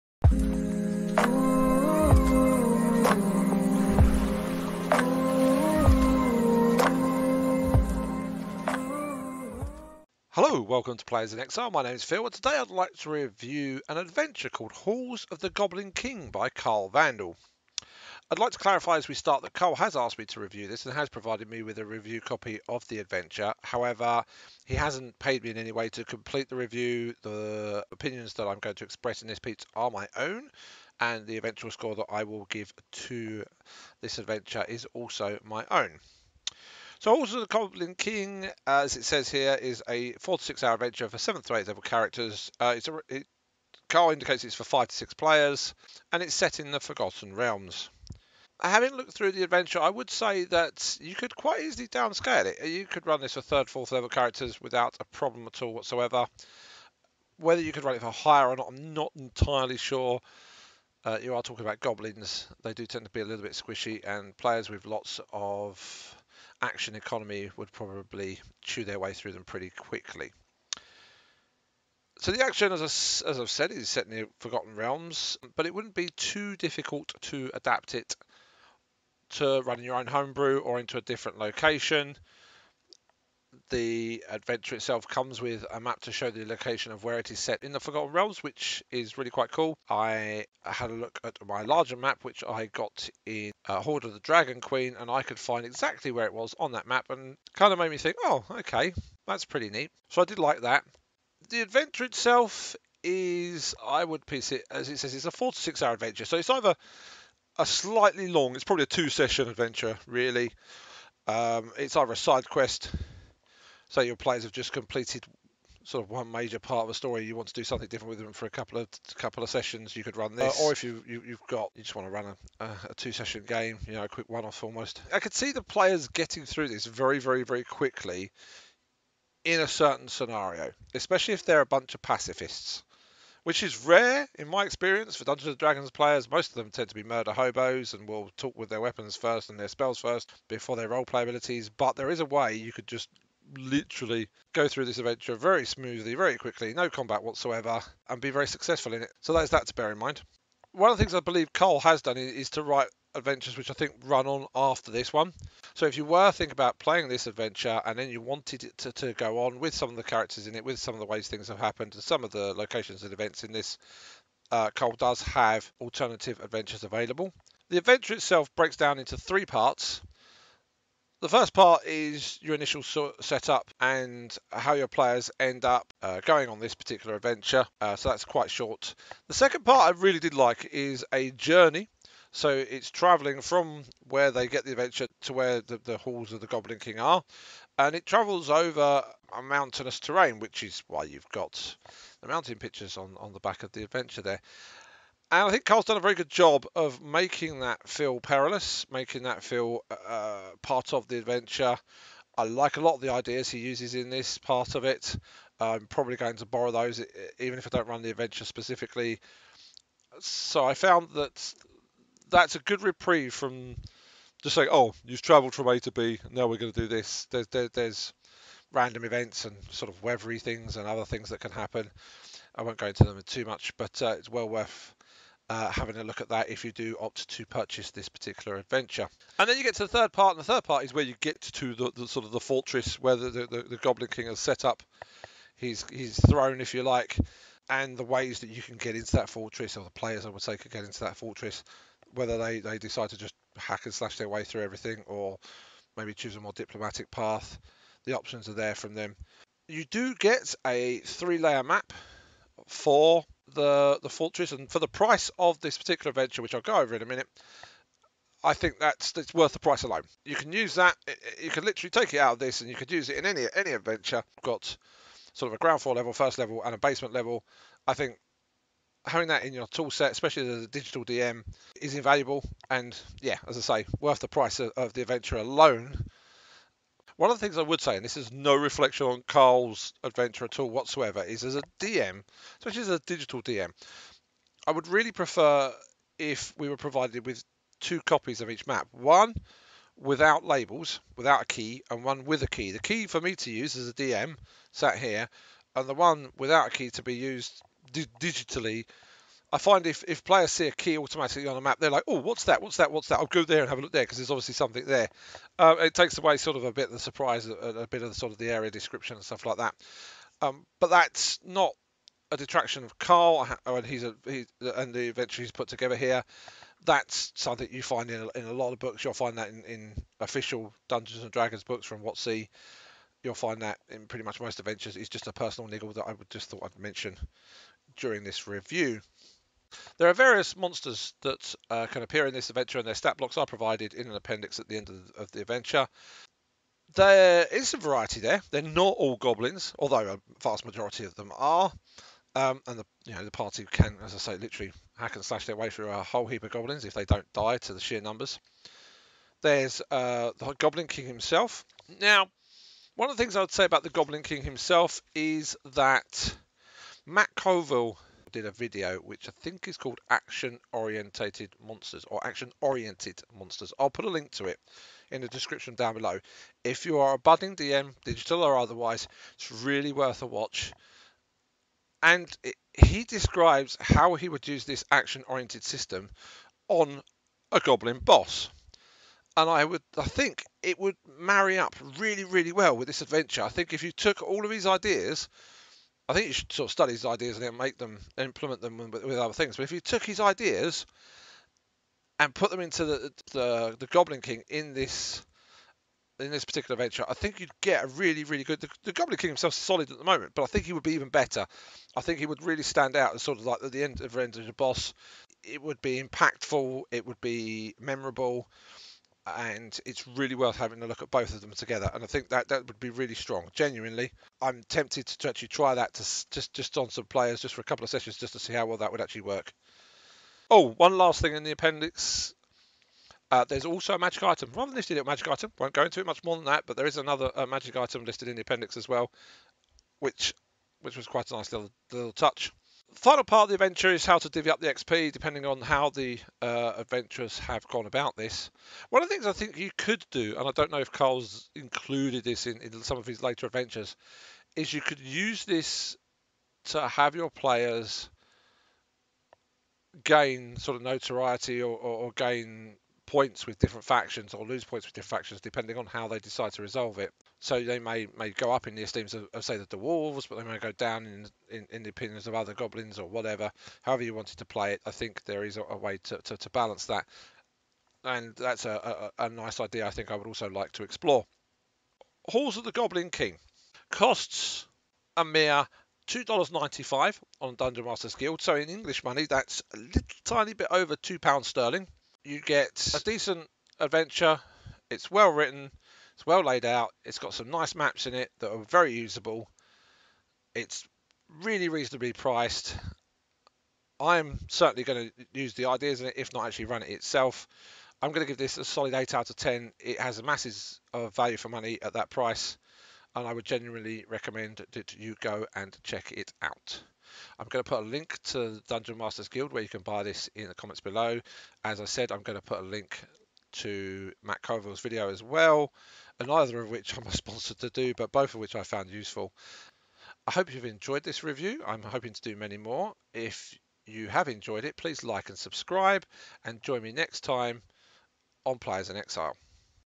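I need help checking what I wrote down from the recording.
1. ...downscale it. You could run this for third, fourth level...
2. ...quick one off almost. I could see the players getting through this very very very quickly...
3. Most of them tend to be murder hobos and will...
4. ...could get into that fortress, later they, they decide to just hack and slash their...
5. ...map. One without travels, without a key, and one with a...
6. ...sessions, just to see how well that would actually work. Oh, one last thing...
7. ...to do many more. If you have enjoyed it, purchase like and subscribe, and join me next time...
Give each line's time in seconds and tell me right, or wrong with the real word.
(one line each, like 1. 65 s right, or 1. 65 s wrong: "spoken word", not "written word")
1. 51 s right
2. 124 s right
3. 136 s right
4. 240 s wrong: "whether", not "later"
5. 288 s wrong: "labels", not "travels"
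6. 417 s right
7. 522 s wrong: "please", not "purchase".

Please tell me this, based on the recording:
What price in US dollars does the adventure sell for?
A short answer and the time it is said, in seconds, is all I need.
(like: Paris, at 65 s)
$2.95, at 476 s.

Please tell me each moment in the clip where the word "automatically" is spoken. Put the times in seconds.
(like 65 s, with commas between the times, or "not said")
300 s.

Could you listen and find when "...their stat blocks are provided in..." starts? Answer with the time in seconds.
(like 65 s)
332 s.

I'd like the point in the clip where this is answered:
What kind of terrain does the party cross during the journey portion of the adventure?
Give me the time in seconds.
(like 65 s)
189 s.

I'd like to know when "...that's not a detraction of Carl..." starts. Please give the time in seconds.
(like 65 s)
310 s.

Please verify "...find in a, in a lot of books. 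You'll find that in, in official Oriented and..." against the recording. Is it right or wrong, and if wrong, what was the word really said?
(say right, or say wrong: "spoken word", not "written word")
wrong: "Dungeons", not "Oriented".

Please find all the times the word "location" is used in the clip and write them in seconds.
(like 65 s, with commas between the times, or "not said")
81 s, 86 s, 162 s.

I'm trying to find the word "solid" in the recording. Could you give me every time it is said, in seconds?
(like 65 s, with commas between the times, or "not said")
399 s, 498 s.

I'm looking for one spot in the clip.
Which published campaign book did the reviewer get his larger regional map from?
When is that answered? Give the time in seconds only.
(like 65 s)
93 s.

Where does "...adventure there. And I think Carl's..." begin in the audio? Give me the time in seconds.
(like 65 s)
193 s.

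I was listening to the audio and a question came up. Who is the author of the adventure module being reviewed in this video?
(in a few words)
Carl Vandal.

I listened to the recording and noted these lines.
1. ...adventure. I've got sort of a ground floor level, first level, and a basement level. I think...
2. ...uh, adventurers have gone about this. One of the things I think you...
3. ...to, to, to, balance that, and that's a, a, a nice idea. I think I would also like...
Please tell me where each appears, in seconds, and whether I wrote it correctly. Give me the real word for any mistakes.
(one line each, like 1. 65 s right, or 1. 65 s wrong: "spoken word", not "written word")
1. 263 s right
2. 436 s right
3. 466 s right.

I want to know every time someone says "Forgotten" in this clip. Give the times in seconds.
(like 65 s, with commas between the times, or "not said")
46 s, 74 s, 87 s.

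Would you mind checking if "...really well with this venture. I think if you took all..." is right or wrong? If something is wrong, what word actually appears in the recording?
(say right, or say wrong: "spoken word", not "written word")
wrong: "adventure", not "venture".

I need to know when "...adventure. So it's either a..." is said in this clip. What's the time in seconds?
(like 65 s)
105 s.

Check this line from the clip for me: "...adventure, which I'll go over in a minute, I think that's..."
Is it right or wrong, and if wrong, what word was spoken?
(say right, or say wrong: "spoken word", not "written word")
right.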